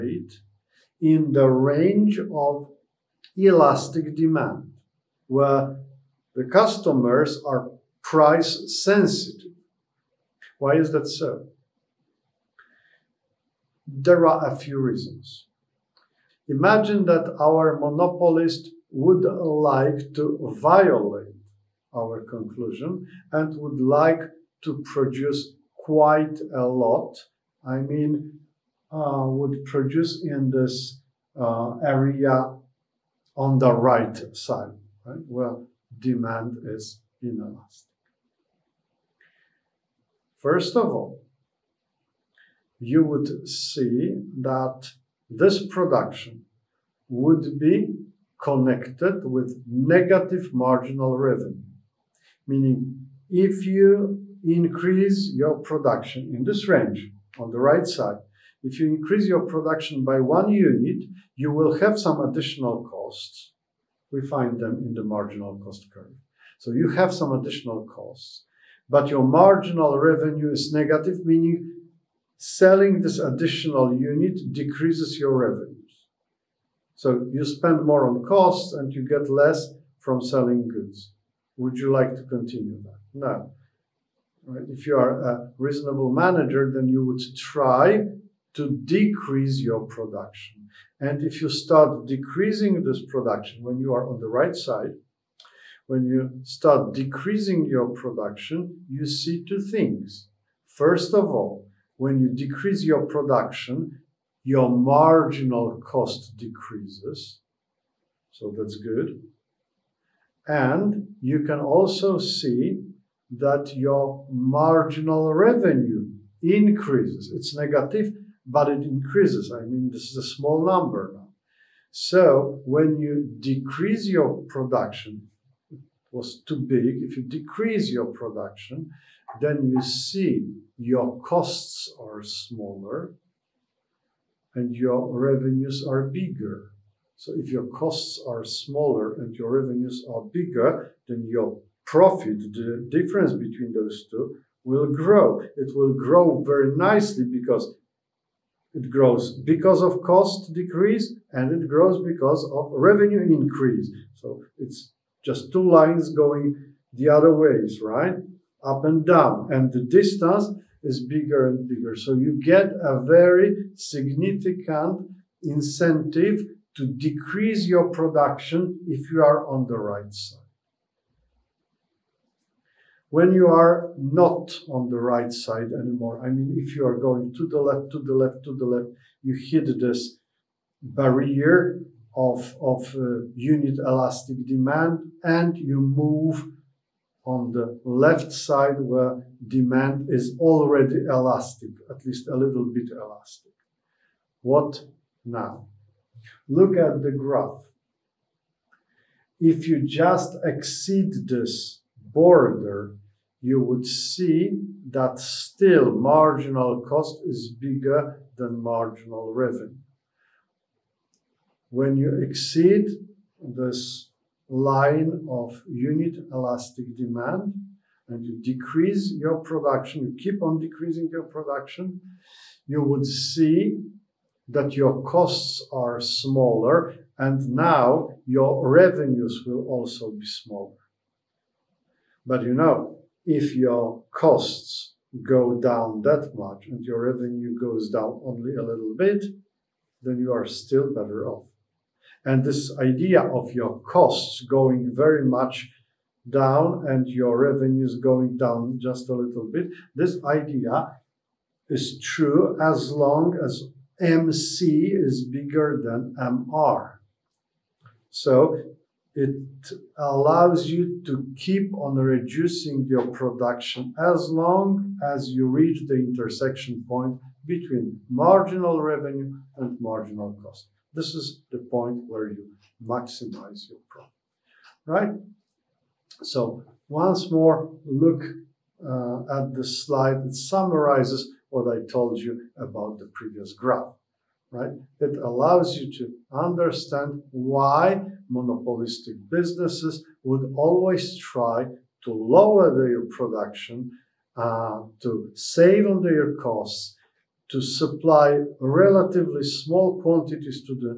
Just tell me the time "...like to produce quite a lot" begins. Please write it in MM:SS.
00:23.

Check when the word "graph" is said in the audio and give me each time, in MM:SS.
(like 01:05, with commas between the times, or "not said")
03:17, 04:43.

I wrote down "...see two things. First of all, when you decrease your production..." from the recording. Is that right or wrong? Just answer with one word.
right.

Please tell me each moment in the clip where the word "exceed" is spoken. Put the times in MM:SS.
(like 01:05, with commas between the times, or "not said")
03:20, 03:32.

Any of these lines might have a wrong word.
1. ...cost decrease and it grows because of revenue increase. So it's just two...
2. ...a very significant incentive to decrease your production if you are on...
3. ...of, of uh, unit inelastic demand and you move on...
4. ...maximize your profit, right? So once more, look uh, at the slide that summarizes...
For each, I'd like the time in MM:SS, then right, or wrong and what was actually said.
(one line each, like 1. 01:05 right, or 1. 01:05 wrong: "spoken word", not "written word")
1. 02:30 right
2. 02:42 right
3. 03:02 wrong: "elastic", not "inelastic"
4. 04:32 right.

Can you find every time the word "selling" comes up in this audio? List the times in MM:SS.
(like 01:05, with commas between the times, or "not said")
01:12, 01:20.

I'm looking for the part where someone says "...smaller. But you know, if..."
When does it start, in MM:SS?
03:50.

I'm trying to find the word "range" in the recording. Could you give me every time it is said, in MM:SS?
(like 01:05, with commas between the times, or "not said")
00:01, 00:56.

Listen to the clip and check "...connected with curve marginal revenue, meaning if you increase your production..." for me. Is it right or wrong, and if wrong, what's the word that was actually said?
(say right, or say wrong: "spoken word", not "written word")
wrong: "negative", not "curve".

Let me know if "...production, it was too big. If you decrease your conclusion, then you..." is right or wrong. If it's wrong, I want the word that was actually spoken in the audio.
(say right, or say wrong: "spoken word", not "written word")
wrong: "production", not "conclusion".